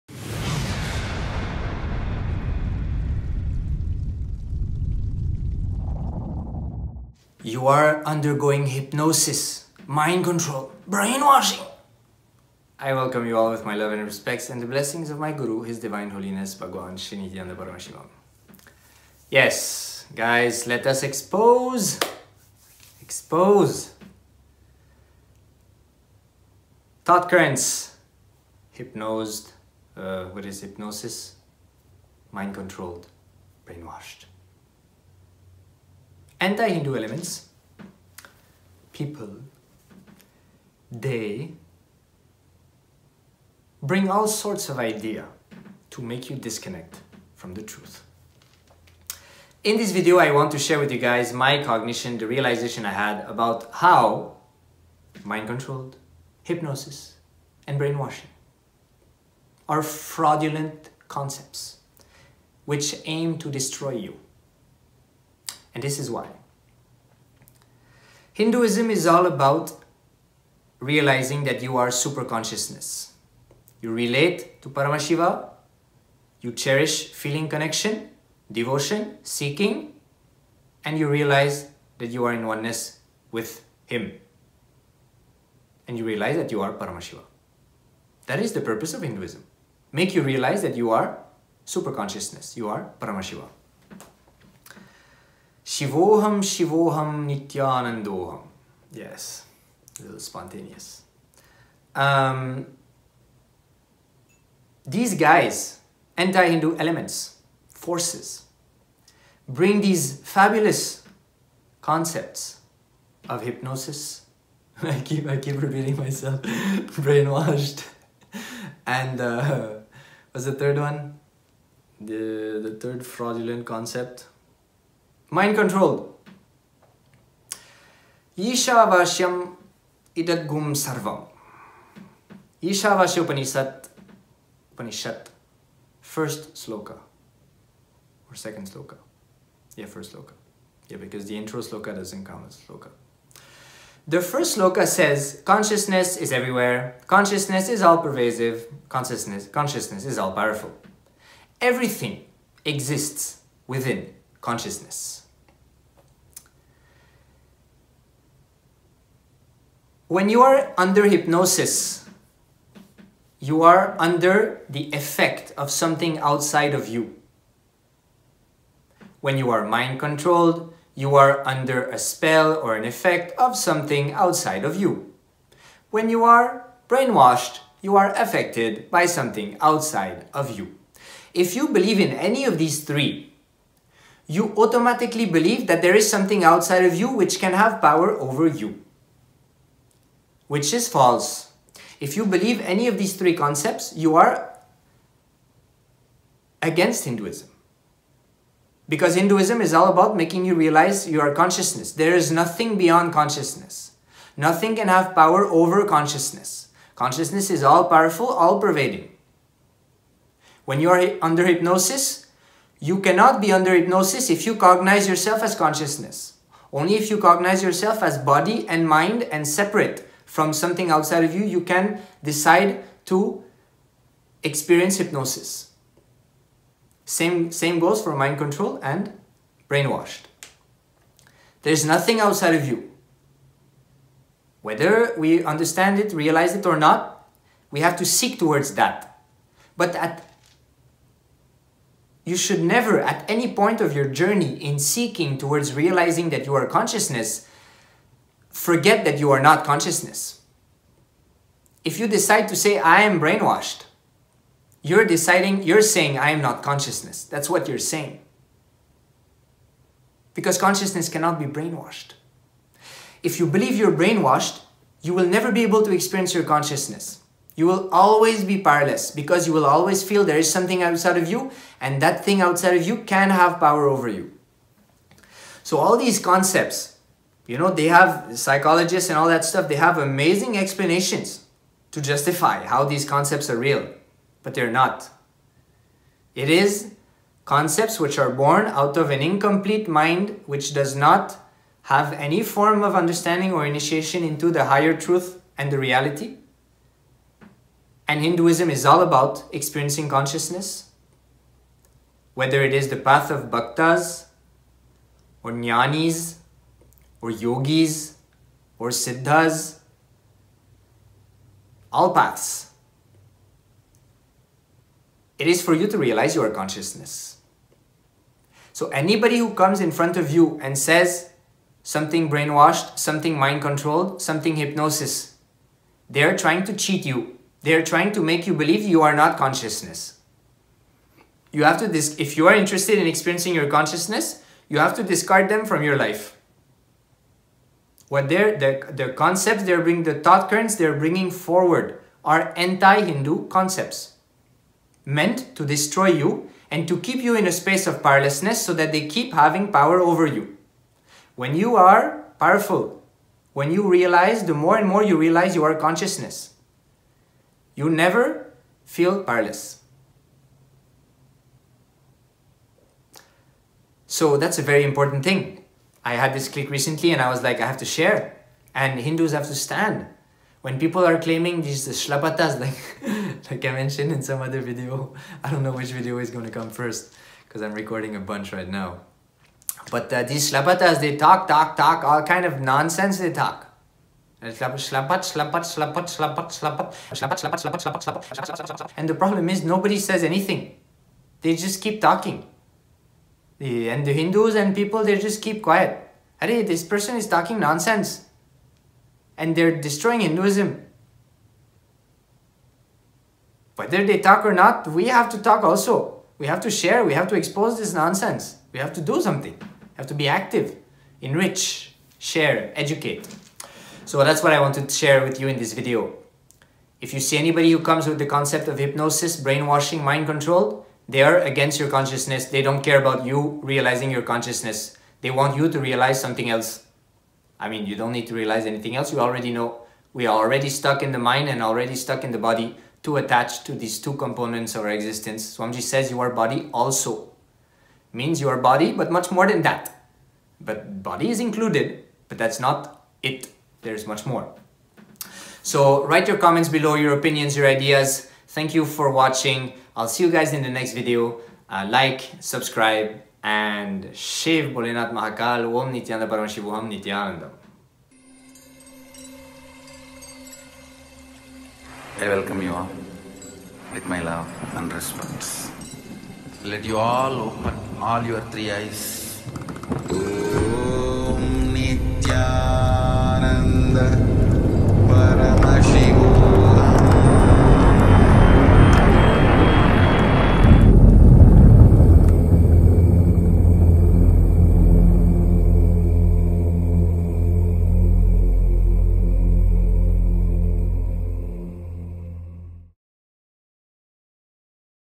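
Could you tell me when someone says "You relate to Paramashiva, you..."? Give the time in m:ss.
1:13.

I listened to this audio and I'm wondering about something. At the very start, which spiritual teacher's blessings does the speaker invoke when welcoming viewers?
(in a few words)
Bhagwan Sri Nithyananda Paramashivam.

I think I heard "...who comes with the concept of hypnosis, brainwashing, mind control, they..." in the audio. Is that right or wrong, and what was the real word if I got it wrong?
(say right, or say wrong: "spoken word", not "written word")
right.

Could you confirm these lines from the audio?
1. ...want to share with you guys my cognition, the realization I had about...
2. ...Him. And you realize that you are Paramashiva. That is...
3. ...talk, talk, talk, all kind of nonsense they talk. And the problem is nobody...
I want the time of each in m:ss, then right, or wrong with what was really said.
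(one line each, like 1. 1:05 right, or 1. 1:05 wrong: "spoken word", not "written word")
1. 0:50 right
2. 1:23 right
3. 6:21 right.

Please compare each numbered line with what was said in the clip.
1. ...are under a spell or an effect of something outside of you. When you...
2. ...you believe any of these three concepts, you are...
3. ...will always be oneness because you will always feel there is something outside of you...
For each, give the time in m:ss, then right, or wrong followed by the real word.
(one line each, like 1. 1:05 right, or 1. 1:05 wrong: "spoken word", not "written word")
1. 2:51 right
2. 3:12 right
3. 4:27 wrong: "powerless", not "oneness".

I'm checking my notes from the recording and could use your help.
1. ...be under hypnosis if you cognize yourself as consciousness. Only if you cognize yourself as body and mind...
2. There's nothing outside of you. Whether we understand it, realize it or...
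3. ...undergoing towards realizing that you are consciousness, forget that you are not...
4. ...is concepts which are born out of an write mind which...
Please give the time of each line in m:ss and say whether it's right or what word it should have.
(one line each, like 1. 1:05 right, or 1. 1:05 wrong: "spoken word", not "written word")
1. 3:33 right
2. 3:51 right
3. 4:04 wrong: "seeking", not "undergoing"
4. 4:46 wrong: "incomplete", not "write".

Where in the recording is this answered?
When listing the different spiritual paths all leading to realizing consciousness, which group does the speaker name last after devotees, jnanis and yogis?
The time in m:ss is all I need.
5:08.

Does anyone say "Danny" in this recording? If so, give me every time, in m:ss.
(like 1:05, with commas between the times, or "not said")
not said.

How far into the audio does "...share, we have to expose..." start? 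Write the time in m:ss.
6:46.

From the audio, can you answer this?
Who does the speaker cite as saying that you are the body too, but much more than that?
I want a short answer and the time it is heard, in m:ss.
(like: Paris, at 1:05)
Swamiji, at 7:15.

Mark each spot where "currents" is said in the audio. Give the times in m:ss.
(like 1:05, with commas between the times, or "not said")
0:27, 5:40.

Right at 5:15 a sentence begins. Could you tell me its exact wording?
It is for you to realize your consciousness.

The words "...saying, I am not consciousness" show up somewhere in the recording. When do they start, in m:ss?
4:15.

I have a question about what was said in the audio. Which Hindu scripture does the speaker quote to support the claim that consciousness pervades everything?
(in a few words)
Ishavasya Upanishad.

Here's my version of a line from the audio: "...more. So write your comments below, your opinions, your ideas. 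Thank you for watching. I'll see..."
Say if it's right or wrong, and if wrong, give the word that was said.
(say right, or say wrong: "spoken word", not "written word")
right.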